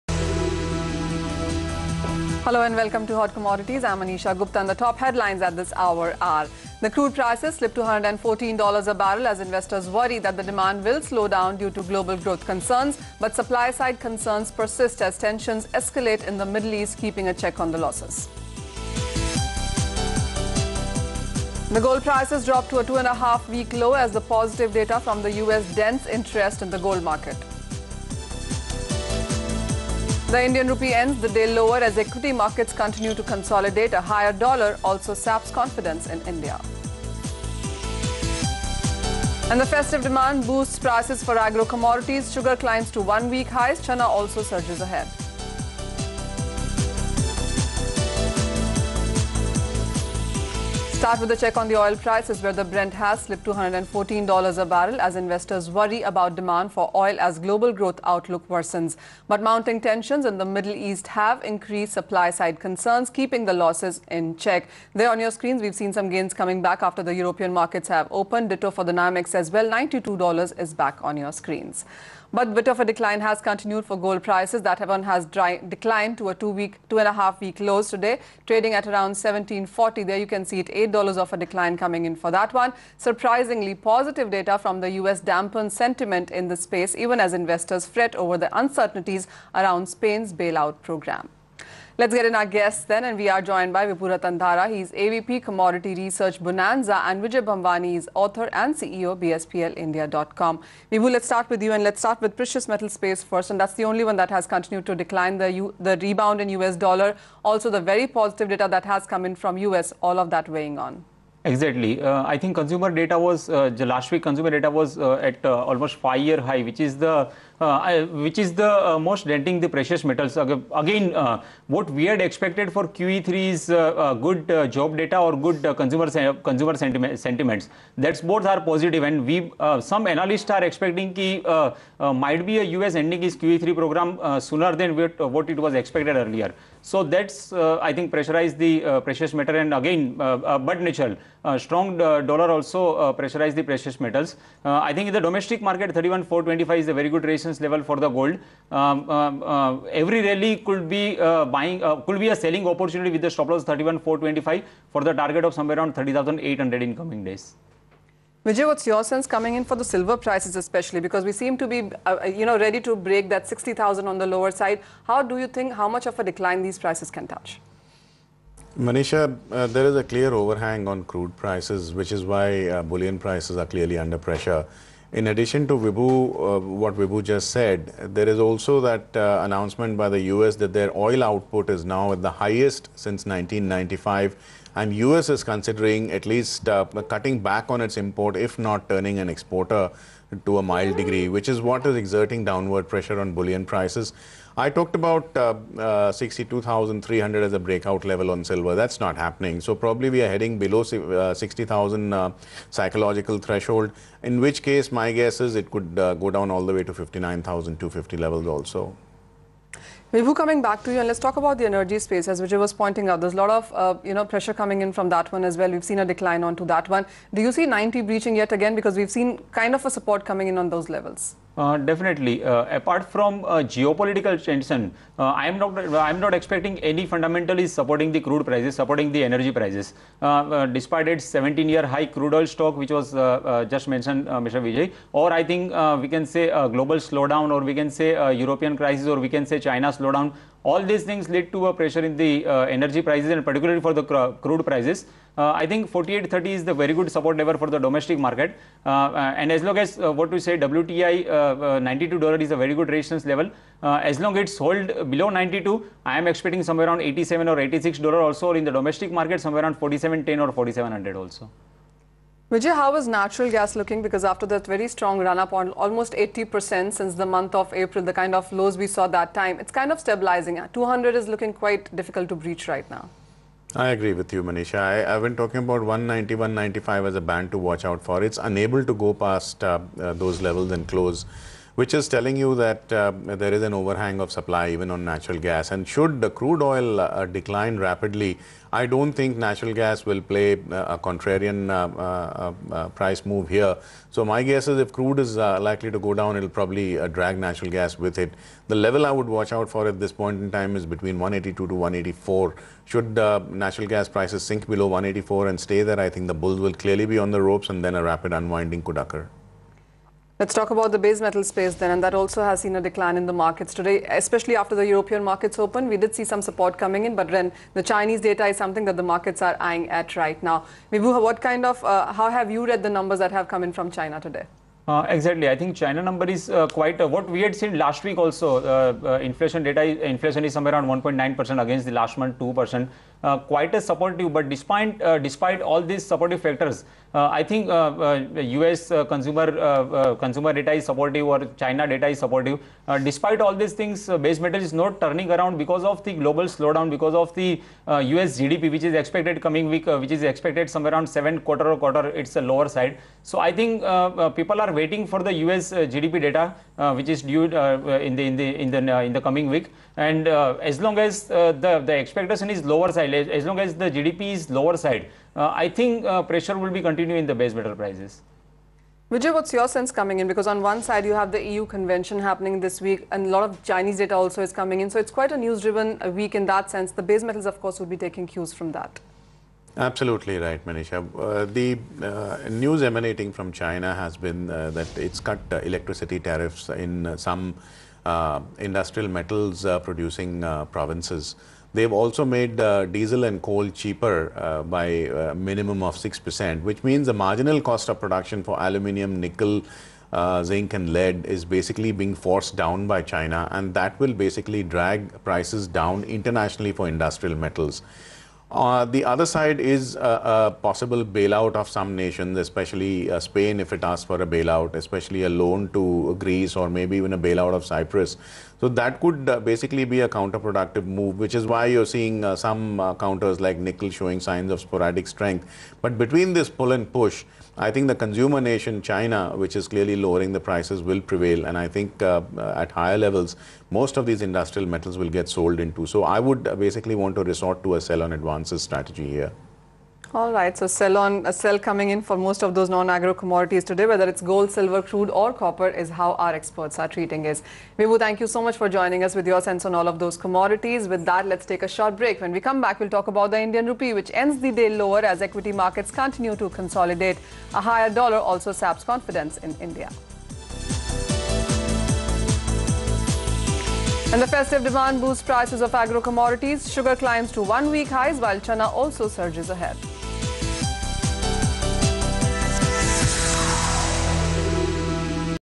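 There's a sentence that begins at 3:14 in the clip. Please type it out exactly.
I talked about uh, uh, 62,300 as a breakout level on silver.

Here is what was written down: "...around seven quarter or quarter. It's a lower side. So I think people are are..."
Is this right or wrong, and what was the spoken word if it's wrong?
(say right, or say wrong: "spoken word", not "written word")
right.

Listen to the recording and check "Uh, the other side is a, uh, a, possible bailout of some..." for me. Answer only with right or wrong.
right.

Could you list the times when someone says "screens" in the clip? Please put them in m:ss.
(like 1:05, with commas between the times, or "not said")
1:05, 1:11.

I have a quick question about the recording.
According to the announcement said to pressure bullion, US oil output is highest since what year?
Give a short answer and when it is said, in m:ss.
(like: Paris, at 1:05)
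1995, at 3:03.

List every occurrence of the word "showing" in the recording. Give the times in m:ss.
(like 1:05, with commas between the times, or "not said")
7:03.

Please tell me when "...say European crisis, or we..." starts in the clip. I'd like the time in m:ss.
3:57.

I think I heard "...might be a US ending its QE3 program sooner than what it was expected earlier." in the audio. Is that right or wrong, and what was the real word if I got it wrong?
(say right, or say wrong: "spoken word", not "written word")
right.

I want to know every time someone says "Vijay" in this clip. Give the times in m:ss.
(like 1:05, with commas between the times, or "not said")
1:37, 2:38, 3:32, 3:54, 4:22, 6:09.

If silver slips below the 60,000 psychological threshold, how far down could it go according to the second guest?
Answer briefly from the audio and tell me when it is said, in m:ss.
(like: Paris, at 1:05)
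59,250, at 3:26.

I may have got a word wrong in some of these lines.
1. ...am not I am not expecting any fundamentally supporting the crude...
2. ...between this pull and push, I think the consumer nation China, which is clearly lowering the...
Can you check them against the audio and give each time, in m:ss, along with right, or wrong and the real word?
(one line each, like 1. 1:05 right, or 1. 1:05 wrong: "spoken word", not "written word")
1. 3:45 right
2. 7:05 right.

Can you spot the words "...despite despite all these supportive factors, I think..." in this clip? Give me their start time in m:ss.
5:34.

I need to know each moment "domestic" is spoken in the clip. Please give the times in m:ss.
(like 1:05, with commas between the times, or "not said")
2:25, 4:07, 4:18.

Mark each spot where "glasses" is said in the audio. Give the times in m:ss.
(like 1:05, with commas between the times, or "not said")
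not said.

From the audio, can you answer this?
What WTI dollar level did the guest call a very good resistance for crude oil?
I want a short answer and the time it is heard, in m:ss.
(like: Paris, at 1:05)
92 dollars, at 4:10.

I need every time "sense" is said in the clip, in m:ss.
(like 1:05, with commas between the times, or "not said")
2:39, 6:09, 6:16, 7:29.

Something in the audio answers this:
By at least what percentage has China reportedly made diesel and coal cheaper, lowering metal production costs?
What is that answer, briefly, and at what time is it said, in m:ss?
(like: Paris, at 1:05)
6%, at 6:35.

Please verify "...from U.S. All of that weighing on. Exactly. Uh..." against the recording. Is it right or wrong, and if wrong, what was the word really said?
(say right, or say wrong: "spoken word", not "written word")
right.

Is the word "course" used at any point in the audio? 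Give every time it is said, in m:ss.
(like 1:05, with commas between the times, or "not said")
6:17.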